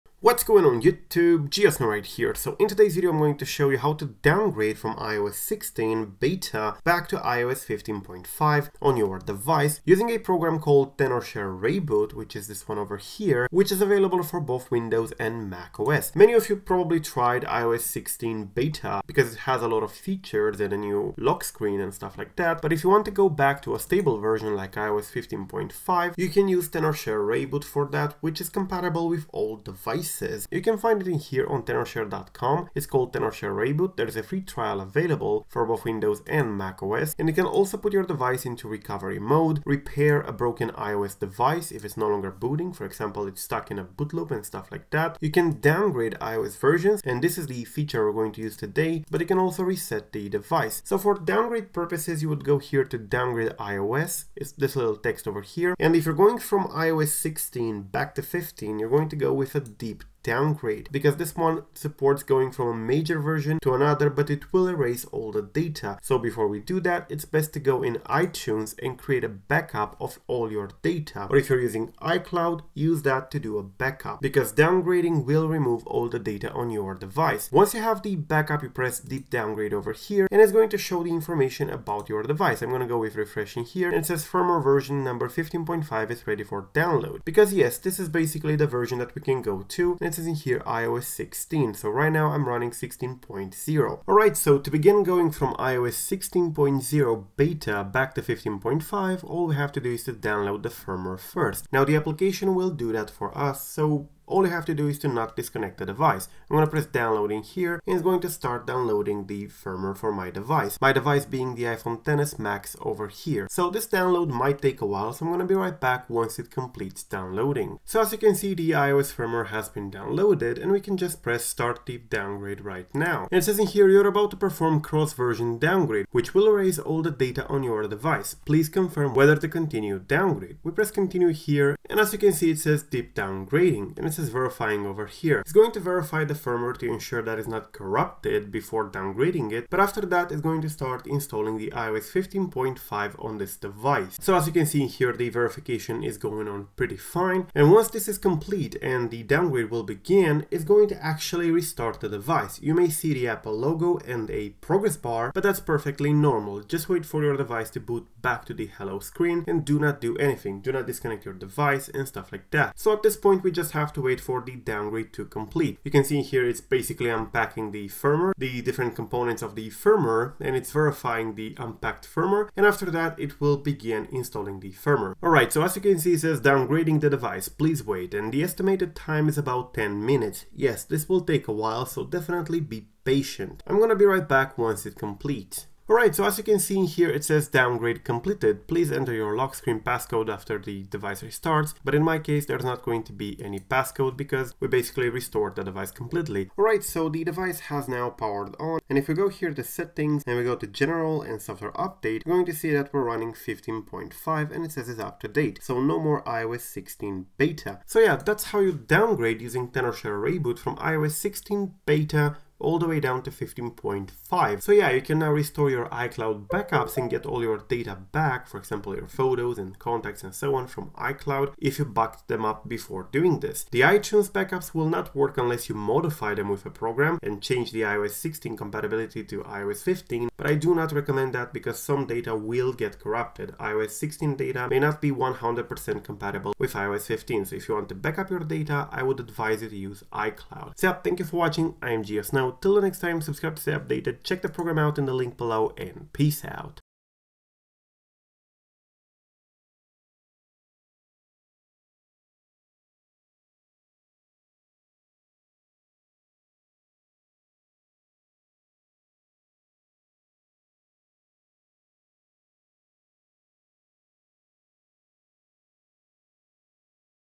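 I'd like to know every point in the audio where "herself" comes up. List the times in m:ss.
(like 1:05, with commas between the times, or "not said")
not said.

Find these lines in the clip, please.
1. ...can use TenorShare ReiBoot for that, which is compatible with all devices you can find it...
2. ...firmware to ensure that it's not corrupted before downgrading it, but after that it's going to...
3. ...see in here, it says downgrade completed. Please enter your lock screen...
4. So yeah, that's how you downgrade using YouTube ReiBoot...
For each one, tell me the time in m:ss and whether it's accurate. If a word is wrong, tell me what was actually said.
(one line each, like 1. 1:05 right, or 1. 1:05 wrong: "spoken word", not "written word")
1. 0:26 right
2. 2:16 right
3. 3:06 right
4. 3:27 wrong: "Tenorshare", not "YouTube".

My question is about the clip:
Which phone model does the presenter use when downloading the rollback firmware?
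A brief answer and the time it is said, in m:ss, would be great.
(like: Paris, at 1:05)
iPhone XS Max, at 1:51.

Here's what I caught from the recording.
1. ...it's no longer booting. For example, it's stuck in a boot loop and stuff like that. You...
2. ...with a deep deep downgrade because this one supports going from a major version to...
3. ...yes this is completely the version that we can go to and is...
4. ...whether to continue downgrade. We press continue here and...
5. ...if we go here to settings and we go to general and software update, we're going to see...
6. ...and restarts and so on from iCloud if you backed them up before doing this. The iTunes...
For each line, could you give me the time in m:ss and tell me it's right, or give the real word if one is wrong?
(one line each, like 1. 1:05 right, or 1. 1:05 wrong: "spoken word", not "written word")
1. 0:41 right
2. 0:59 right
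3. 1:27 wrong: "basically", not "completely"
4. 2:09 right
5. 3:18 right
6. 3:39 wrong: "contacts", not "restarts".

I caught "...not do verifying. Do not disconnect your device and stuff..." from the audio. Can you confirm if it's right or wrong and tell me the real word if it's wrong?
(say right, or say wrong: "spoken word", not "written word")
wrong: "anything", not "verifying".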